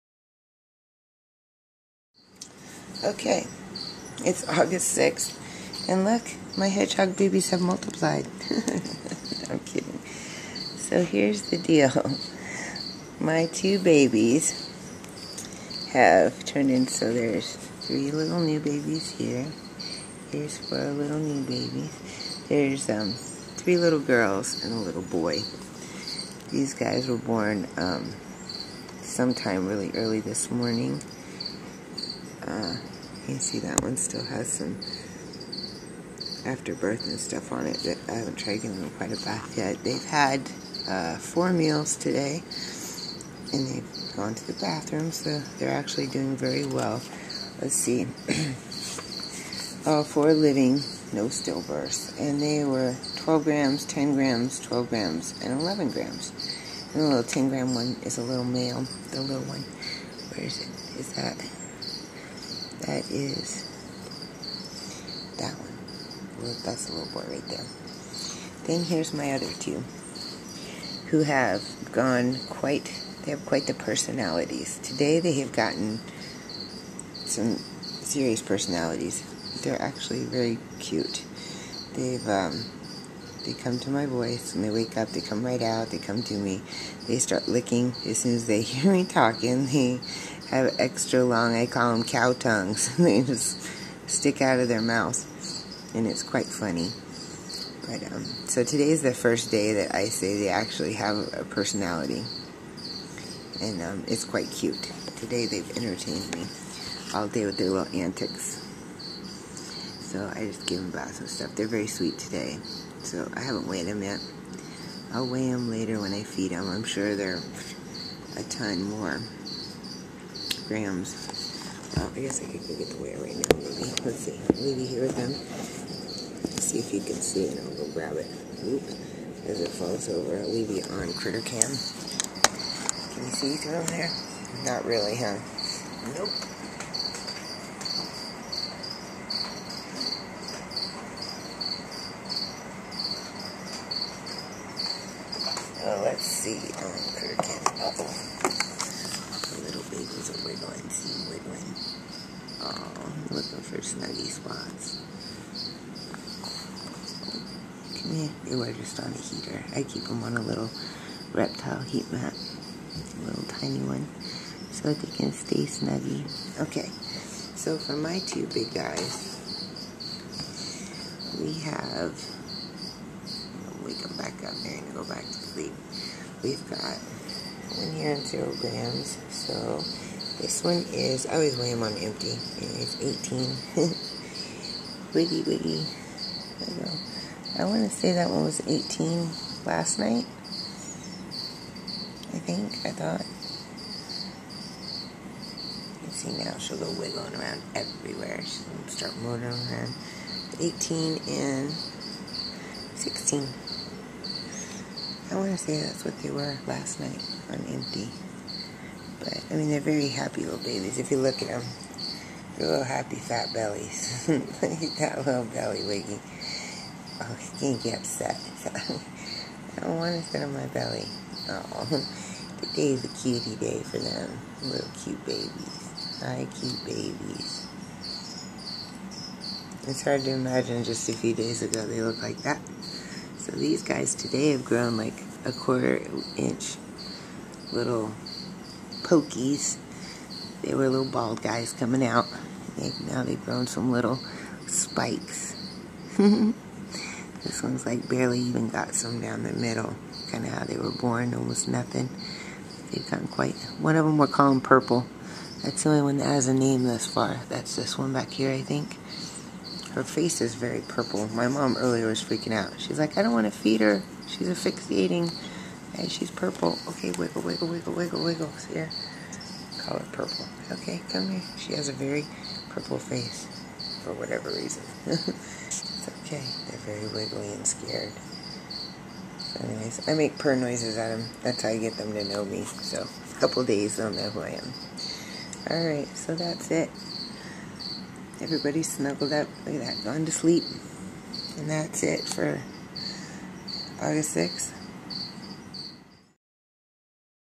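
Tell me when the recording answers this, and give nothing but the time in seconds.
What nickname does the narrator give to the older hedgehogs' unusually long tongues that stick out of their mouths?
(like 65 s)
92 s.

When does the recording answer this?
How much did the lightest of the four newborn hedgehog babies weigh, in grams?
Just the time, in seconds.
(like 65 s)
53 s.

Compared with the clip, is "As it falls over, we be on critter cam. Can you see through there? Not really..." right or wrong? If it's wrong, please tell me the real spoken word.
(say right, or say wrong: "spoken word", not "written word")
right.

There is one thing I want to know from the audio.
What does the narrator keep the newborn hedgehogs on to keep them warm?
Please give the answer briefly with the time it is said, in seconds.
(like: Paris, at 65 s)
reptile heat mat, at 161 s.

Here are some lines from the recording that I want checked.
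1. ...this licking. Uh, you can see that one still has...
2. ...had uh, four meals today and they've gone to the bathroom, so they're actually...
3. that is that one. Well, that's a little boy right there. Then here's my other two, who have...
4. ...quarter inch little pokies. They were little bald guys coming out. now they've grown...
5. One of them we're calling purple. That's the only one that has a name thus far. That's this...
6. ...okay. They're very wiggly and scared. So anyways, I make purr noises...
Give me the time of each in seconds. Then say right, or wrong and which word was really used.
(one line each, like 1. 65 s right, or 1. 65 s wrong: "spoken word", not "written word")
1. 30 s wrong: "morning", not "licking"
2. 40 s right
3. 62 s right
4. 235 s right
5. 253 s right
6. 276 s right.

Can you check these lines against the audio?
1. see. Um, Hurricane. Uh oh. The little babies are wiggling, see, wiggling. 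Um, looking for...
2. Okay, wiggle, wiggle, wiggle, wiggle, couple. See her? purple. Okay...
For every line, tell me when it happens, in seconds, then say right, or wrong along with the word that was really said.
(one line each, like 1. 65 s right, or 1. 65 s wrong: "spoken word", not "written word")
1. 146 s right
2. 266 s wrong: "wiggle", not "couple".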